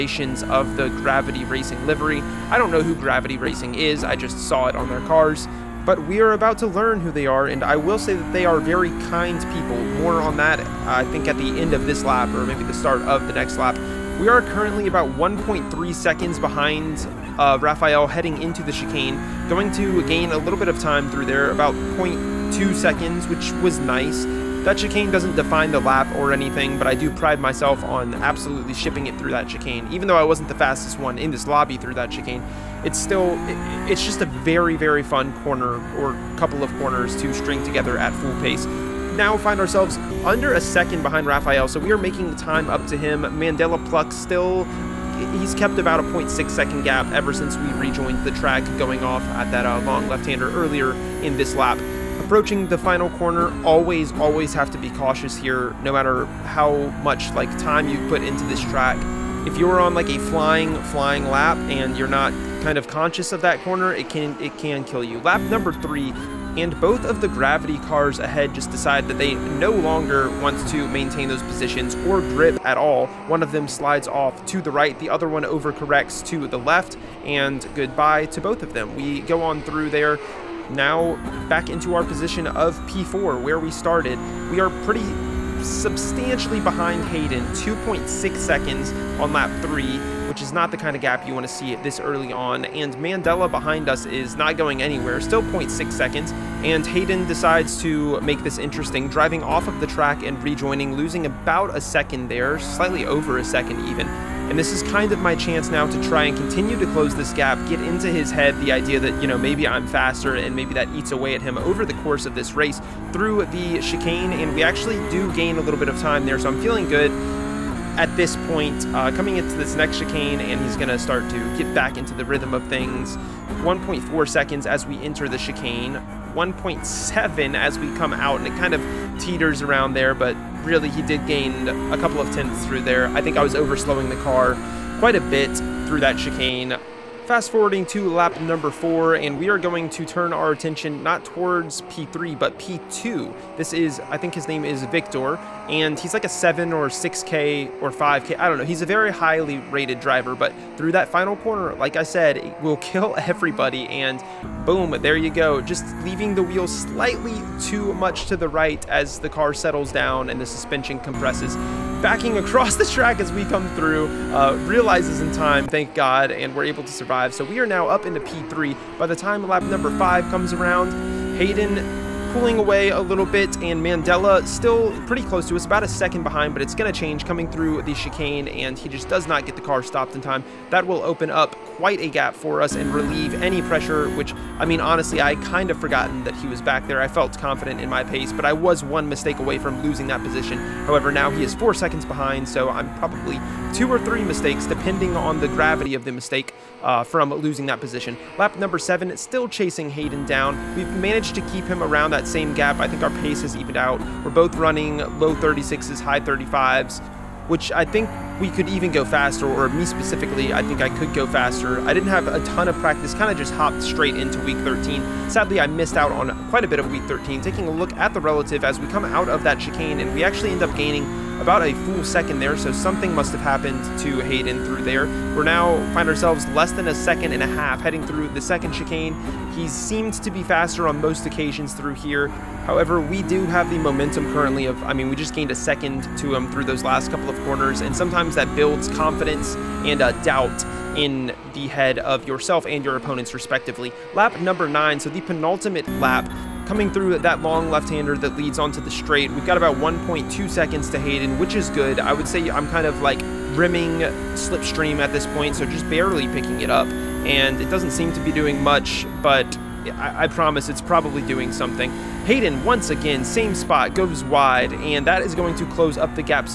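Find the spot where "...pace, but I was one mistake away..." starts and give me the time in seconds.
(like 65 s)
188 s.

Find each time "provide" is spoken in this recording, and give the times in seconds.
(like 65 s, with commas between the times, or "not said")
not said.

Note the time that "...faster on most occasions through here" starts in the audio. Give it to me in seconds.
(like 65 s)
230 s.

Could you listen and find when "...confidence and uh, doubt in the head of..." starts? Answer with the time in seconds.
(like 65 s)
238 s.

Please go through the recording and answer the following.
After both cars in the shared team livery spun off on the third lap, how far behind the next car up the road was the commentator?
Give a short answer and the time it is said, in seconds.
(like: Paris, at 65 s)
2.6 seconds, at 87 s.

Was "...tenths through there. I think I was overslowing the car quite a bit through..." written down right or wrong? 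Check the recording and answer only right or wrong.
right.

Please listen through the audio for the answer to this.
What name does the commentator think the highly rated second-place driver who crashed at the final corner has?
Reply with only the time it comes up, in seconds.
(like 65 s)
144 s.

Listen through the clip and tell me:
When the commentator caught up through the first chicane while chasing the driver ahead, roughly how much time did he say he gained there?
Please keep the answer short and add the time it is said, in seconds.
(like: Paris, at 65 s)
0.2 seconds, at 21 s.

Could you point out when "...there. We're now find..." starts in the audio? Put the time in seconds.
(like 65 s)
224 s.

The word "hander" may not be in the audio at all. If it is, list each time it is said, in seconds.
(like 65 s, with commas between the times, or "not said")
50 s, 247 s.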